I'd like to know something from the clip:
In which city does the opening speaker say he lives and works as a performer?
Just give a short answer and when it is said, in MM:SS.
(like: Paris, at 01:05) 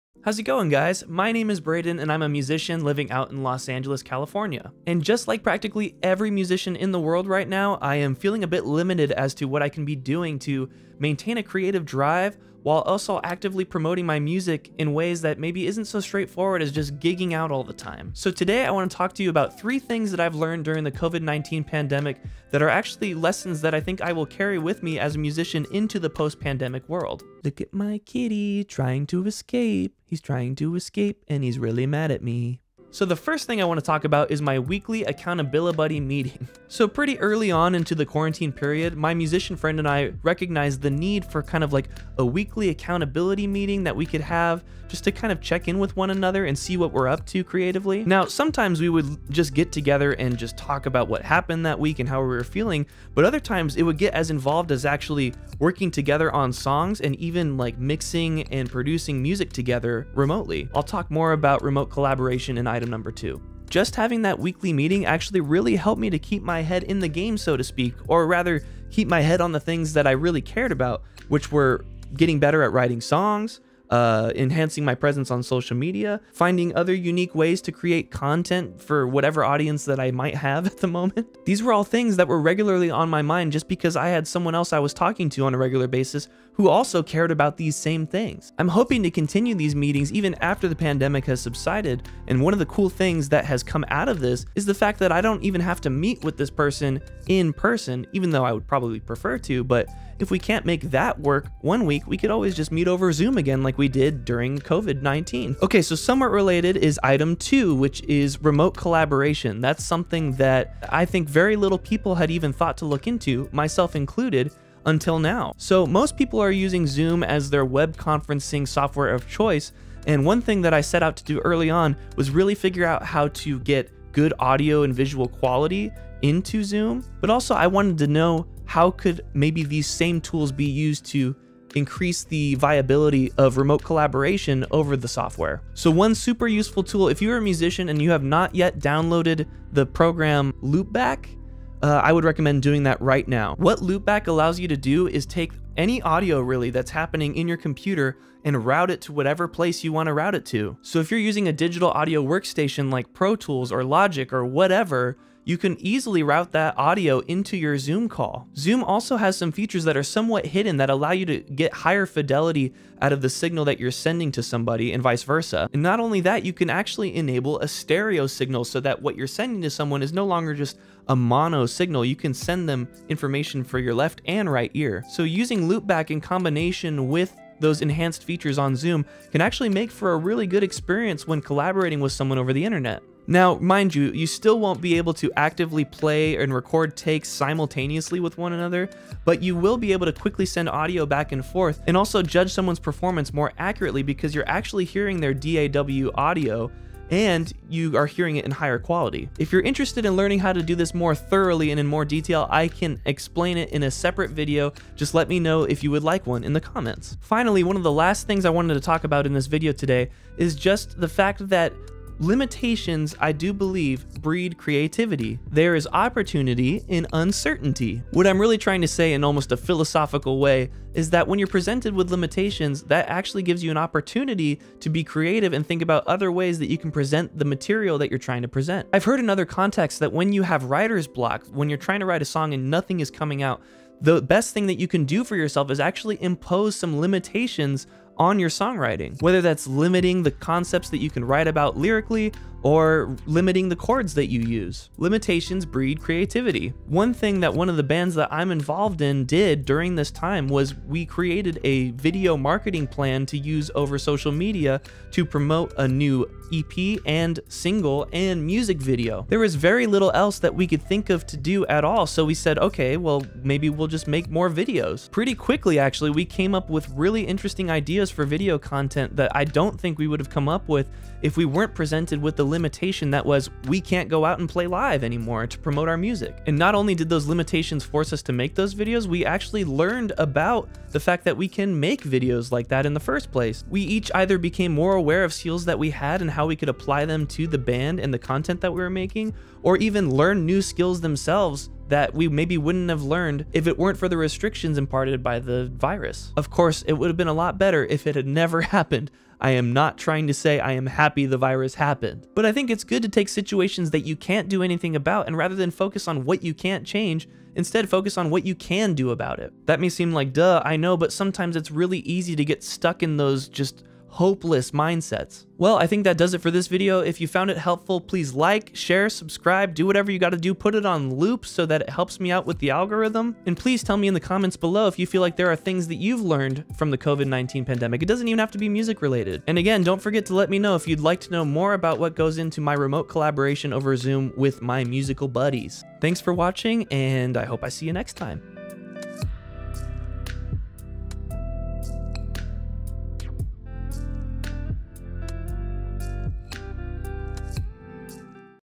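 Los Angeles, at 00:03.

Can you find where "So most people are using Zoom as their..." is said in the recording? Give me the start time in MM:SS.
01:55.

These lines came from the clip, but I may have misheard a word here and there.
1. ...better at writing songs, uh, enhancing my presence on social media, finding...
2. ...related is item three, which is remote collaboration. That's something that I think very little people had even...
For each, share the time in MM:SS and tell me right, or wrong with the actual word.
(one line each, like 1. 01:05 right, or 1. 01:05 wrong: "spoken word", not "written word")
1. 01:12 right
2. 01:46 wrong: "two", not "three".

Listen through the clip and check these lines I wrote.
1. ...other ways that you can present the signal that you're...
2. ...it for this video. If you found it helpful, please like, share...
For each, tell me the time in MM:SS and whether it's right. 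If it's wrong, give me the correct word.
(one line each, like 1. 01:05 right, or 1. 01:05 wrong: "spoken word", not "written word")
1. 03:46 wrong: "material", not "signal"
2. 05:16 right.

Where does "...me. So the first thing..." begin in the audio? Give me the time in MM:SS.
00:32.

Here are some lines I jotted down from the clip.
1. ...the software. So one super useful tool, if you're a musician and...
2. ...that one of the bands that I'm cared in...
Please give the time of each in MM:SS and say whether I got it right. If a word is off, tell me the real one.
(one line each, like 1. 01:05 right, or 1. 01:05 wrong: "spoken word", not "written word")
1. 02:14 right
2. 04:07 wrong: "involved", not "cared".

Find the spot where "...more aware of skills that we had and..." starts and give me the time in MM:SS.
04:44.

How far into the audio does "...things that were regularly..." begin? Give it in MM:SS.
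01:21.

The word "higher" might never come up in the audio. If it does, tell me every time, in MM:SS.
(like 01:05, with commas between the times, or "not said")
02:41, 03:18.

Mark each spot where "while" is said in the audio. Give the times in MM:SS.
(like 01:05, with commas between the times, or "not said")
00:12.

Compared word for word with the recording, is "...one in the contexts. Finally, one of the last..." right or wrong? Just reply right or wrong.
wrong.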